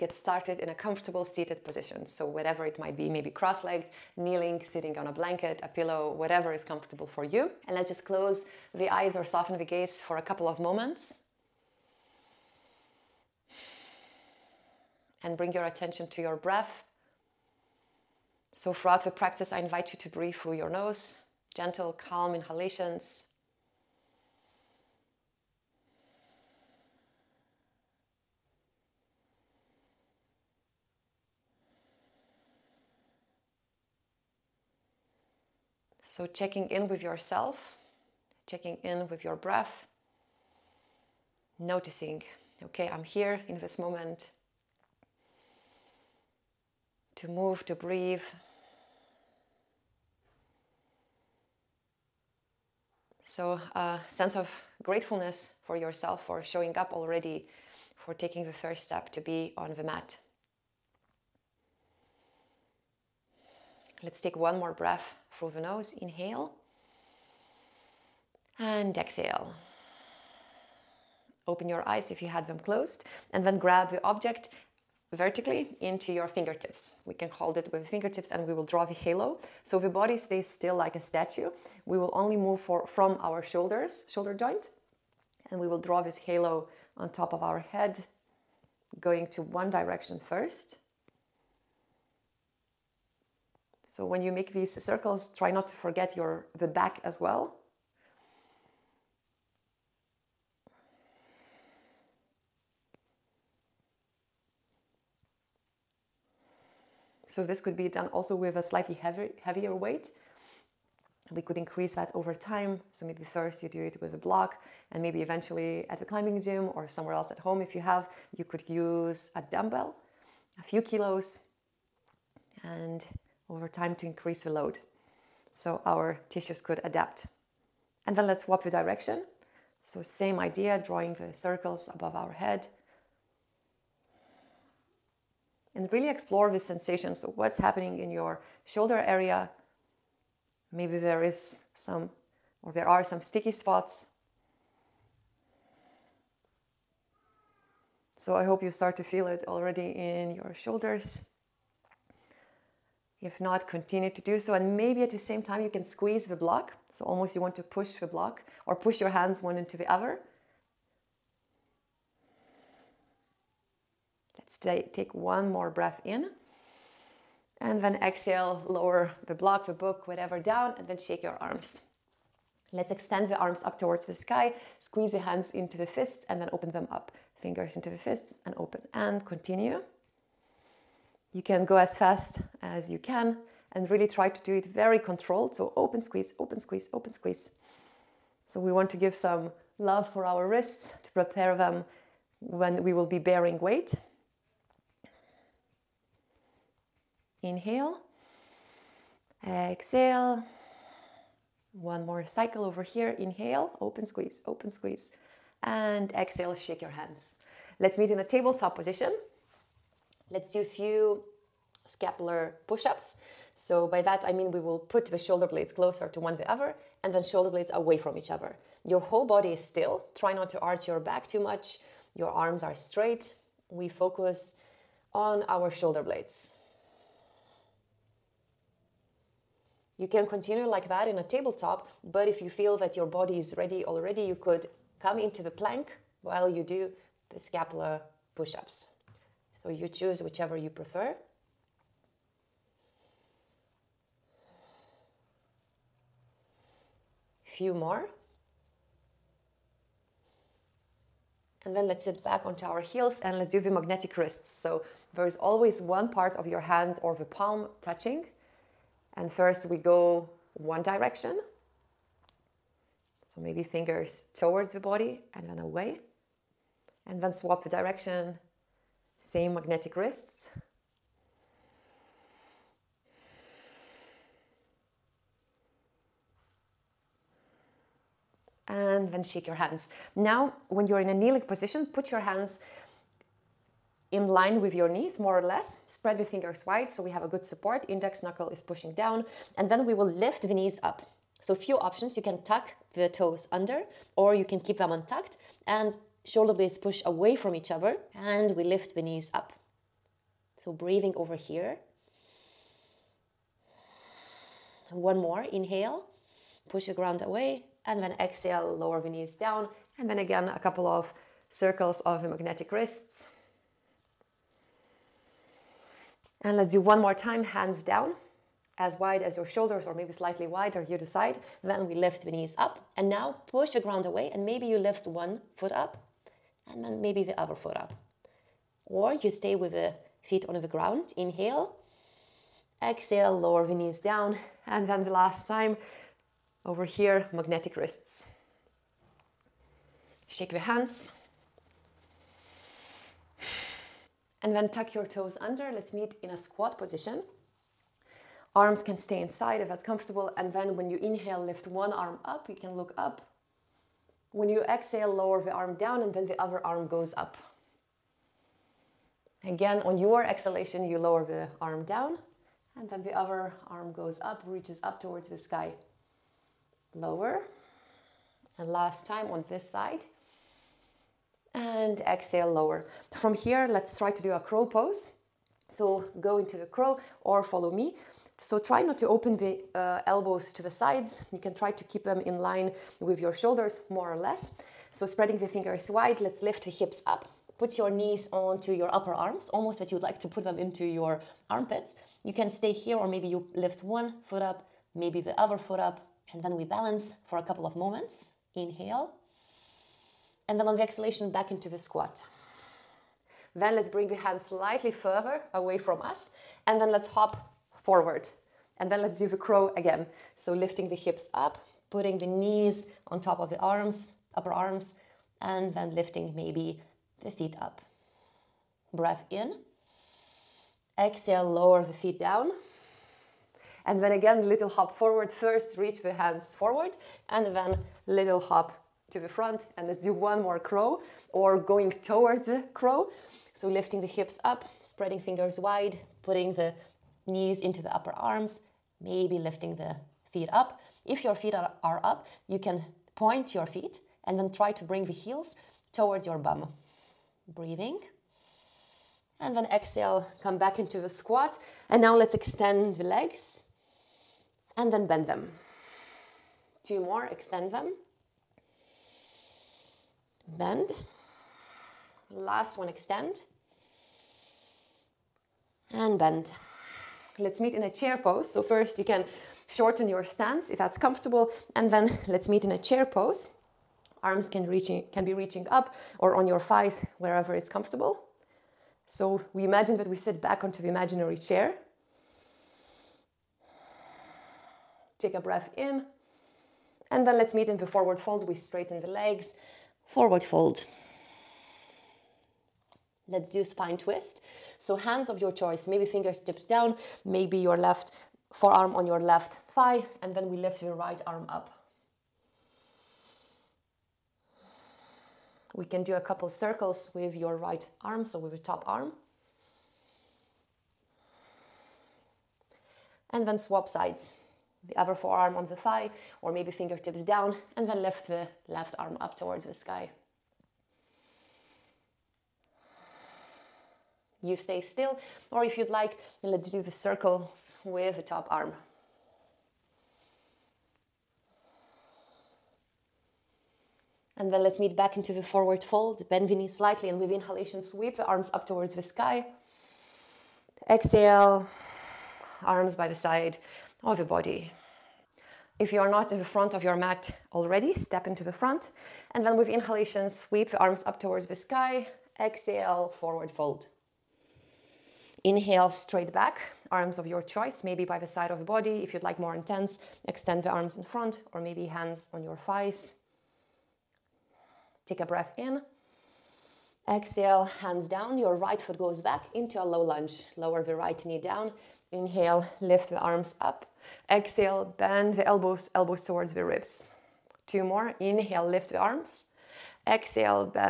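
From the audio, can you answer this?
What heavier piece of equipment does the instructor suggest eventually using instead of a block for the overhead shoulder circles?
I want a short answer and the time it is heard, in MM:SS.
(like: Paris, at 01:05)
dumbbell, at 01:59.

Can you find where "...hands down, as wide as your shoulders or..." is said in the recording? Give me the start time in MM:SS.
05:17.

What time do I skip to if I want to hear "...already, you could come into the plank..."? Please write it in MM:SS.
03:53.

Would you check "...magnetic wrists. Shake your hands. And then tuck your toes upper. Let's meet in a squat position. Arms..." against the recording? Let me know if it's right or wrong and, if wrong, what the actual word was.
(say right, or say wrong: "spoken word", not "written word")
wrong: "under", not "upper".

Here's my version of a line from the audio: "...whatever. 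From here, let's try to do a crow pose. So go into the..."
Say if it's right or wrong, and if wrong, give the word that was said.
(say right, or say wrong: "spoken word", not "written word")
wrong: "lower", not "whatever".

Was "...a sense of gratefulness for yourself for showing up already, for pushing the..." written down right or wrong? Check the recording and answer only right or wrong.
wrong.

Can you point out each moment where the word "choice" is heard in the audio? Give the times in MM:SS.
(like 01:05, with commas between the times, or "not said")
08:15, 09:17.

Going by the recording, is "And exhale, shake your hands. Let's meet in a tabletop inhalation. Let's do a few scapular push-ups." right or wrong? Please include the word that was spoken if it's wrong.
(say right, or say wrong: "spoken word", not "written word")
wrong: "position", not "inhalation".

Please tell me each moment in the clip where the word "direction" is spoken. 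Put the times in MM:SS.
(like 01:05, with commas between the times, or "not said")
01:29, 02:08, 04:20, 04:27.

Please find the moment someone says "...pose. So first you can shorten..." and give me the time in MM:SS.
07:48.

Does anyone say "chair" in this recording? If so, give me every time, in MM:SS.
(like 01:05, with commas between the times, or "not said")
07:47, 07:52, 08:01.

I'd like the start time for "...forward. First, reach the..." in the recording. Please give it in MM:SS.
07:04.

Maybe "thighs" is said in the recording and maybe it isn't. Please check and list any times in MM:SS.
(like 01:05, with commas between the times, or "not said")
07:56, 08:19, 08:35, 09:22.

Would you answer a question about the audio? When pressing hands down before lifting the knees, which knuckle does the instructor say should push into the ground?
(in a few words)
index knuckle.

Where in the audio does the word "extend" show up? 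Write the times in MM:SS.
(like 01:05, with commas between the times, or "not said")
02:52, 07:32, 07:37, 07:42, 09:20.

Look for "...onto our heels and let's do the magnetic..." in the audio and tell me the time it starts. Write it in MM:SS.
04:12.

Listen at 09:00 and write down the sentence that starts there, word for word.
Exhale, arms by the side of the body.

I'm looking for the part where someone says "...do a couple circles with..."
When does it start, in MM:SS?
08:26.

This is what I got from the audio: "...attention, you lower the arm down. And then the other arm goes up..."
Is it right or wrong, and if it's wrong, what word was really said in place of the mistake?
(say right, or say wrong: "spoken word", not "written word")
wrong: "exhalation", not "attention".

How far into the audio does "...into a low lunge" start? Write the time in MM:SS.
09:29.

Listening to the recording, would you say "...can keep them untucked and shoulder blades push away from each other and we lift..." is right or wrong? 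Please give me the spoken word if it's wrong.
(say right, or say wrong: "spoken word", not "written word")
right.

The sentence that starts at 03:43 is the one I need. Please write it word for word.
We focus on our shoulder blades.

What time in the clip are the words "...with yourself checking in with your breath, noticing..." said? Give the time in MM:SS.
00:36.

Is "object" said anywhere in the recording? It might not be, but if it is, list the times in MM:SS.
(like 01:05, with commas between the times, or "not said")
01:14.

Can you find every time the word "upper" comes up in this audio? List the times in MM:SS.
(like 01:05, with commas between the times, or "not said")
06:28, 06:54, 07:17.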